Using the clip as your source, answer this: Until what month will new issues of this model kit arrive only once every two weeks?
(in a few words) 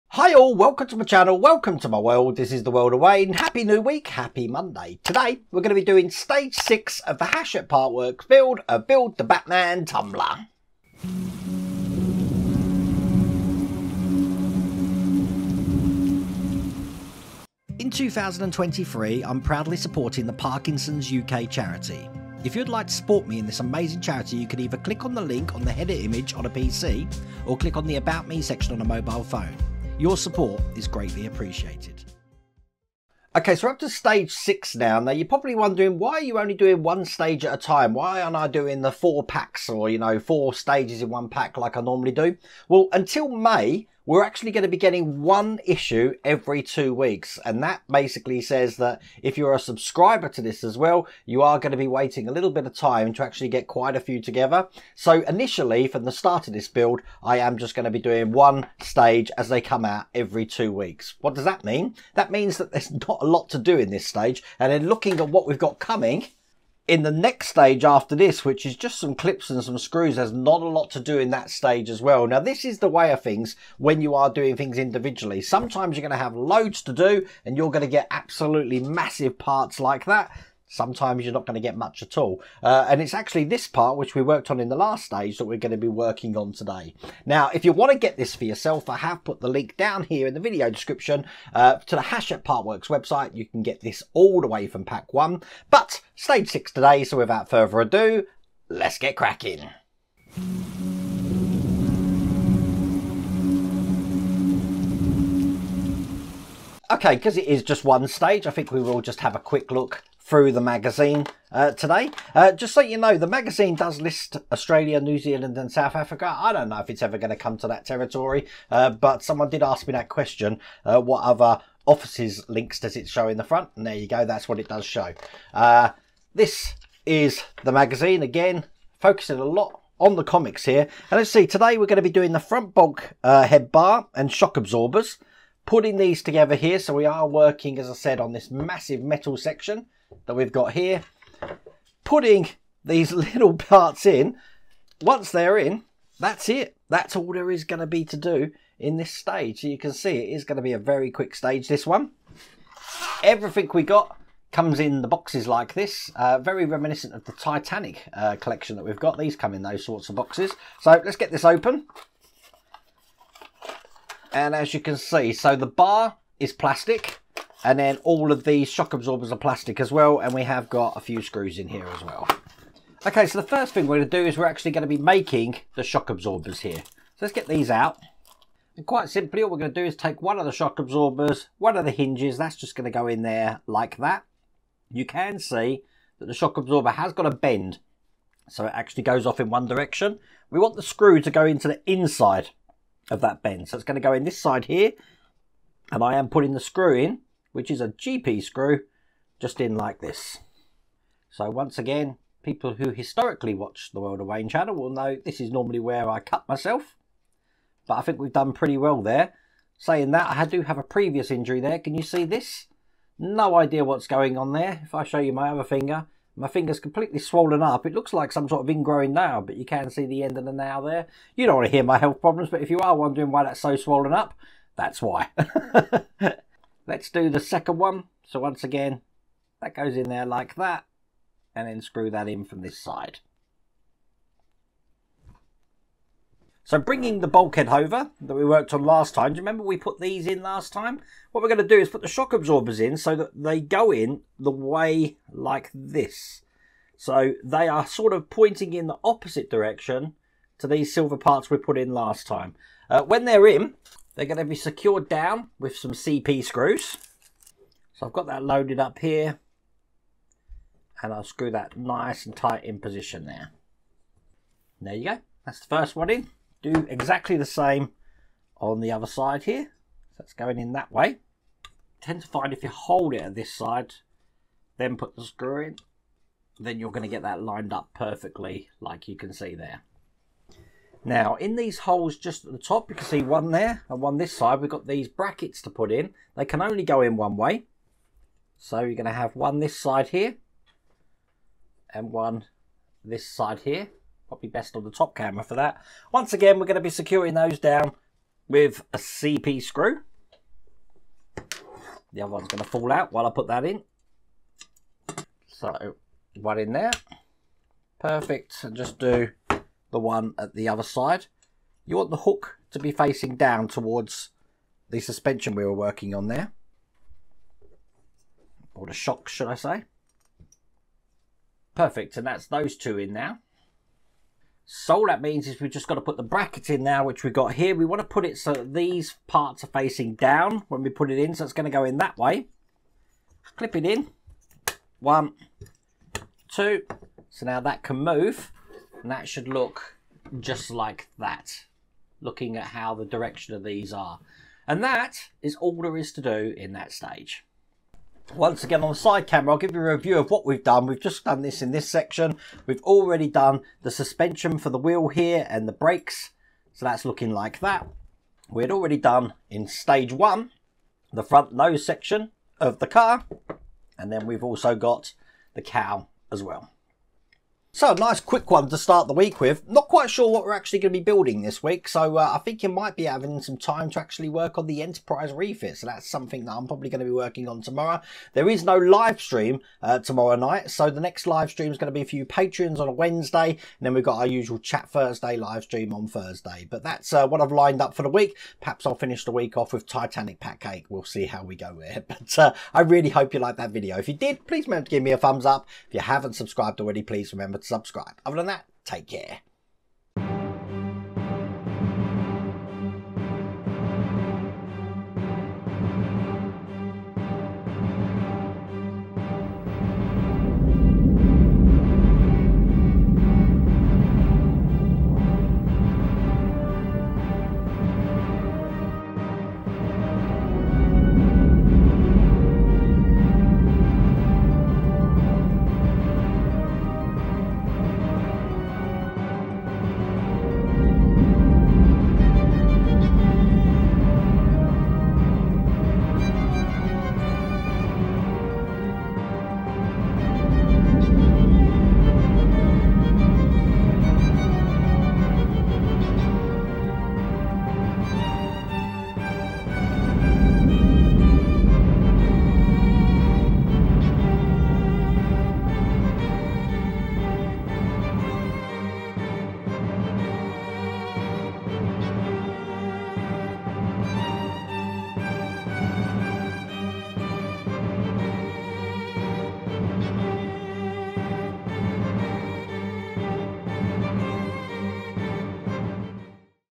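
May.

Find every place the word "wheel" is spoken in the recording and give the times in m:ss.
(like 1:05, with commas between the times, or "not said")
5:54.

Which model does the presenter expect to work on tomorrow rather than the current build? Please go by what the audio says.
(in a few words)
Enterprise refit.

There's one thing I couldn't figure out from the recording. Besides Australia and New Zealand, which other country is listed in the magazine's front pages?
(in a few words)
South Africa.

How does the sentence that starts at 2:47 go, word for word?
And then all of these shock absorbers are plastic as well.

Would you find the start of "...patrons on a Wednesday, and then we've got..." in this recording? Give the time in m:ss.
6:22.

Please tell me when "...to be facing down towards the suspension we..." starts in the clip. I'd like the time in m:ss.
5:12.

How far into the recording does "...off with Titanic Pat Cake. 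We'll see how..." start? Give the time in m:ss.
6:29.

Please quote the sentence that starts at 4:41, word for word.
Now, in these holes just at the top, you can see one there and one this side.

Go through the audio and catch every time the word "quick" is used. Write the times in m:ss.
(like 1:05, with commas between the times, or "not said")
1:49, 2:31, 6:08.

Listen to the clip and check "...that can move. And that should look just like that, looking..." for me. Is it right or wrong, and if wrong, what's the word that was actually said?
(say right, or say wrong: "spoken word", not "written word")
right.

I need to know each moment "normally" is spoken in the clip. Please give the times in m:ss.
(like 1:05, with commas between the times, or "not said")
0:41, 3:25.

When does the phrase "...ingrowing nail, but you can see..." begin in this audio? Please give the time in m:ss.
3:38.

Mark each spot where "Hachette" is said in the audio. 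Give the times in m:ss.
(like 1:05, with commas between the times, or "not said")
0:07, 1:32.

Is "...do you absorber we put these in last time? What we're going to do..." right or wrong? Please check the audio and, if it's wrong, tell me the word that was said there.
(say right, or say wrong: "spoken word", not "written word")
wrong: "remember", not "absorber".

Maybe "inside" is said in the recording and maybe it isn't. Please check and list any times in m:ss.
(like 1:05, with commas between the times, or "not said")
3:11.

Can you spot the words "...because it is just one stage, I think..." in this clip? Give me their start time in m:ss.
1:47.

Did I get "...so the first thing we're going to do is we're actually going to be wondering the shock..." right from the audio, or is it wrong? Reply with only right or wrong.
wrong.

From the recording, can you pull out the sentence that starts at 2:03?
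And there you go, that's what it does show.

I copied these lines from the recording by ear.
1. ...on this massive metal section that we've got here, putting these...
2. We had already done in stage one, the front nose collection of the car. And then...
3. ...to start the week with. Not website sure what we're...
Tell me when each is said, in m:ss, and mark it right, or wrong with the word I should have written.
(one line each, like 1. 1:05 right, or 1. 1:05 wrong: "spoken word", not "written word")
1. 2:18 right
2. 5:58 wrong: "section", not "collection"
3. 6:08 wrong: "quite", not "website".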